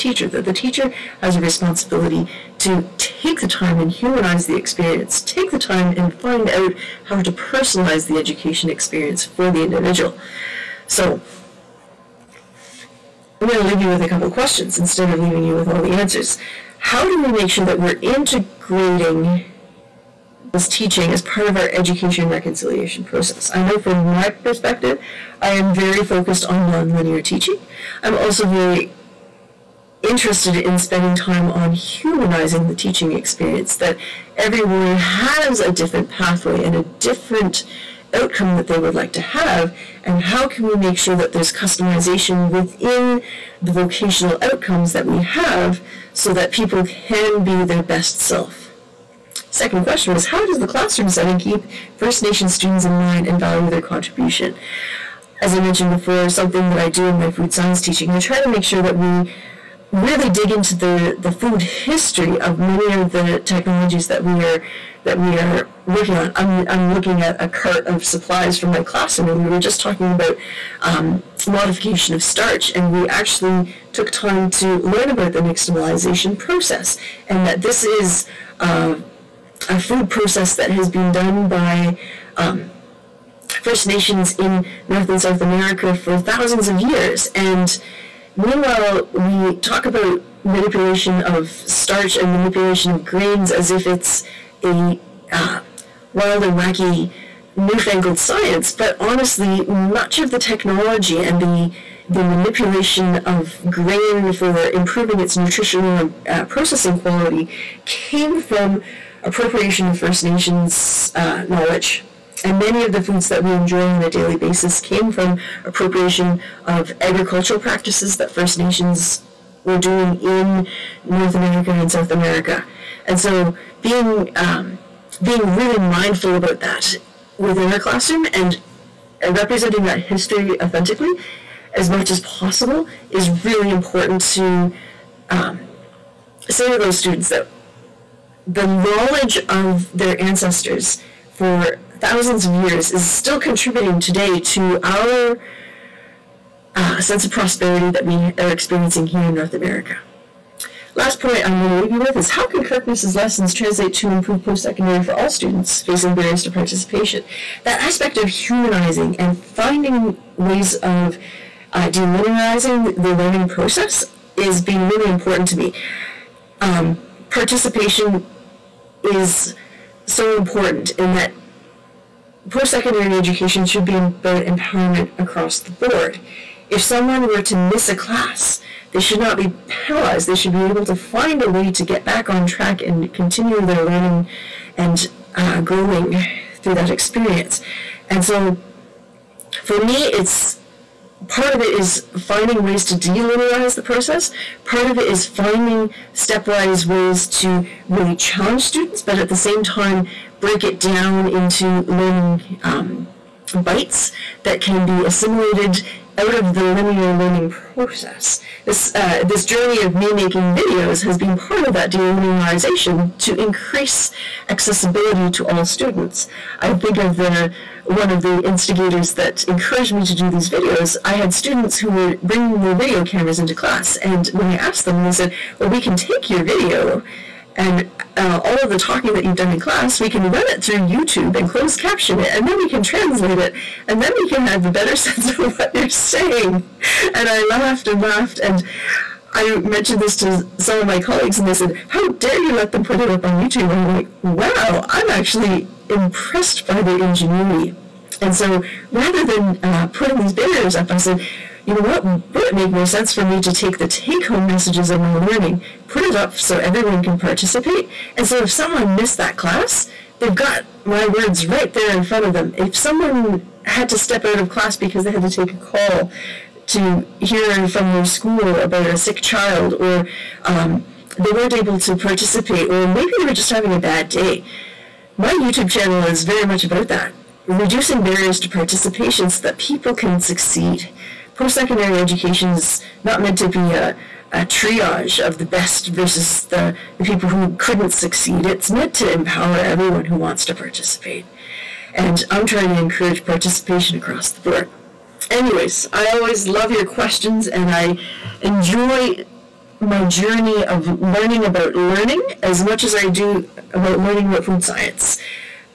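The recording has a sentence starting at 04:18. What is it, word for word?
And so if someone missed that class, they've got my words right there in front of them.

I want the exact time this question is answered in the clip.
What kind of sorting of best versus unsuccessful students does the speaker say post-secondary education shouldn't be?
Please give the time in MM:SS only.
04:44.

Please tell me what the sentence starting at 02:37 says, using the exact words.
That aspect of humanizing and finding ways of uh, delinearizing the learning process is being really important to me.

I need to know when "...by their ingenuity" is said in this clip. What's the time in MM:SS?
04:06.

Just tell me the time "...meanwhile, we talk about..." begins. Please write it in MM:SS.
01:28.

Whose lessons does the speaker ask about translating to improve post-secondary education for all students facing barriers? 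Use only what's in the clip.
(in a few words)
Kirkness.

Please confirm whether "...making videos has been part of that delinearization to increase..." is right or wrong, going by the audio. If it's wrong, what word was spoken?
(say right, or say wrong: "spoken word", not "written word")
right.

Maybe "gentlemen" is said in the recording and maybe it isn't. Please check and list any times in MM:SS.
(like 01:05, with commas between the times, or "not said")
not said.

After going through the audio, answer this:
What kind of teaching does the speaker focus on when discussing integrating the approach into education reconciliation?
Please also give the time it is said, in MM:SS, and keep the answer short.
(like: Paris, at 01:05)
nonlinear teaching, at 00:26.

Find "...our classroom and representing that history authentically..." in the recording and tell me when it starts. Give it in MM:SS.
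02:07.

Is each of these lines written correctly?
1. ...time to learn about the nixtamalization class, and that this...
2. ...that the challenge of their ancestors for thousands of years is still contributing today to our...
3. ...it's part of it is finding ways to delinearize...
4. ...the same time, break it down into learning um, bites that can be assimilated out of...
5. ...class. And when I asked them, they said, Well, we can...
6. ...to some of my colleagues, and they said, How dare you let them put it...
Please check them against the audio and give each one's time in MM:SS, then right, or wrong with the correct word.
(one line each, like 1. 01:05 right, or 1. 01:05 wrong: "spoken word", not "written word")
1. 01:14 wrong: "process", not "class"
2. 02:17 wrong: "knowledge", not "challenge"
3. 03:10 right
4. 03:19 right
5. 03:43 right
6. 04:00 right.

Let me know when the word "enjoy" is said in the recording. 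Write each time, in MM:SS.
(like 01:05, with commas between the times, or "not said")
01:53, 04:58.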